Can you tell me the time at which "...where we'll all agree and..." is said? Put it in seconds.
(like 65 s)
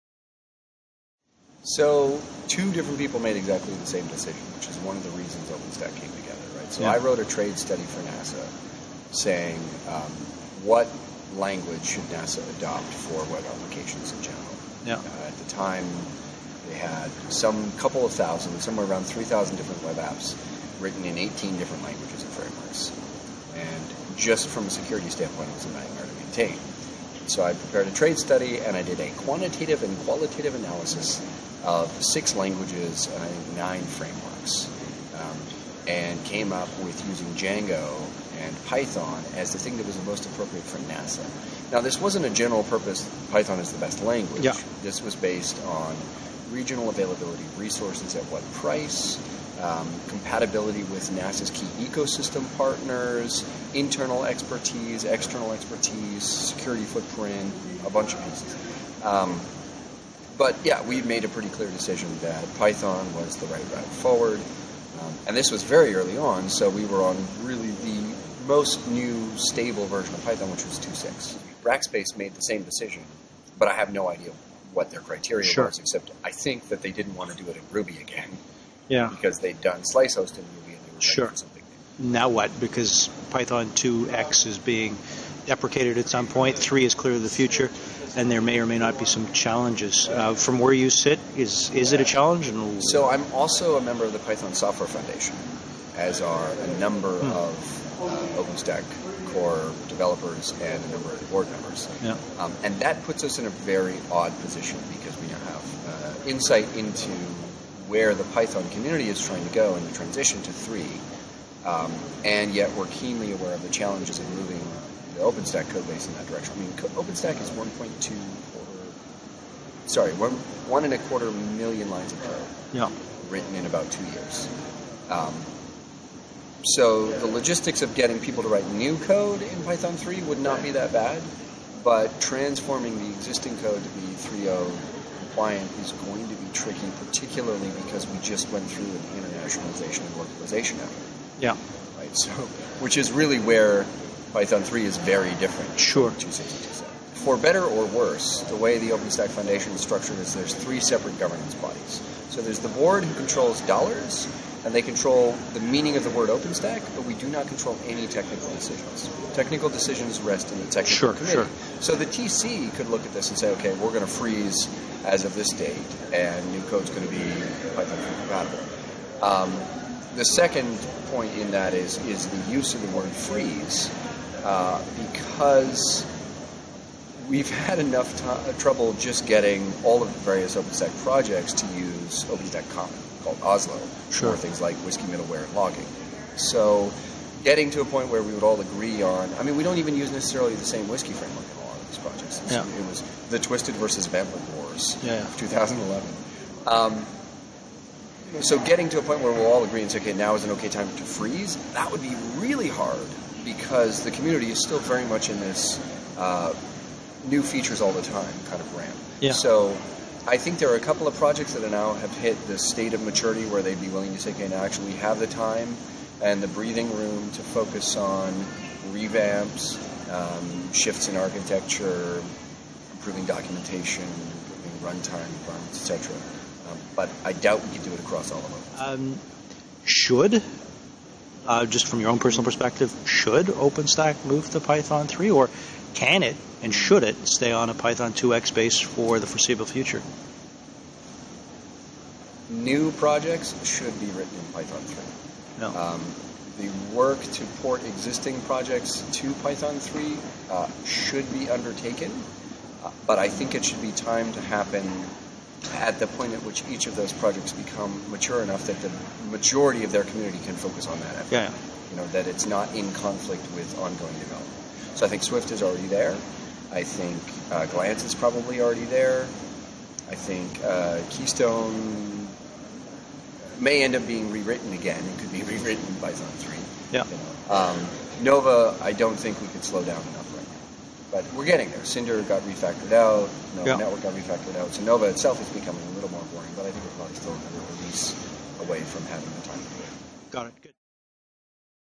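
199 s.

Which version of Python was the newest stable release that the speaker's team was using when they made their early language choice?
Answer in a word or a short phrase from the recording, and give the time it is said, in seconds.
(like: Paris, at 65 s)
2.6, at 70 s.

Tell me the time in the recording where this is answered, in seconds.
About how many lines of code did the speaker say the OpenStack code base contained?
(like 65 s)
120 s.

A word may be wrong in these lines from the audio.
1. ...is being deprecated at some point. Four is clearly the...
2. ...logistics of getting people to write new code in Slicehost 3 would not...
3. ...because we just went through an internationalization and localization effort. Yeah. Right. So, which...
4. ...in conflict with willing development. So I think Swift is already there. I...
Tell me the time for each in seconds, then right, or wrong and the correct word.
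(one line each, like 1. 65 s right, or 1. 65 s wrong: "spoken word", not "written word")
1. 84 s wrong: "Three", not "Four"
2. 127 s wrong: "Python", not "Slicehost"
3. 137 s right
4. 262 s wrong: "ongoing", not "willing".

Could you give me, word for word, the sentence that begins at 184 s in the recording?
things like WSGI middleware and logging.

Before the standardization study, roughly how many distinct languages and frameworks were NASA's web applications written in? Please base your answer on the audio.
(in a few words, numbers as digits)
18.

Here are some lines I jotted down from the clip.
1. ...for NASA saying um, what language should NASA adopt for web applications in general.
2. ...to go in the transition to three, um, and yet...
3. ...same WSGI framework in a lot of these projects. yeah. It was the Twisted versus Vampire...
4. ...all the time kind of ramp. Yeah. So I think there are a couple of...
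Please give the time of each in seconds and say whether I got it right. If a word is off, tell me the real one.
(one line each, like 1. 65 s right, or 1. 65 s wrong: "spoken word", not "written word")
1. 7 s right
2. 109 s right
3. 190 s right
4. 207 s right.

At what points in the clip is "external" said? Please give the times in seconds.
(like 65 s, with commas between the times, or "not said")
55 s.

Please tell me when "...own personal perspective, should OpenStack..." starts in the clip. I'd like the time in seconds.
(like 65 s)
232 s.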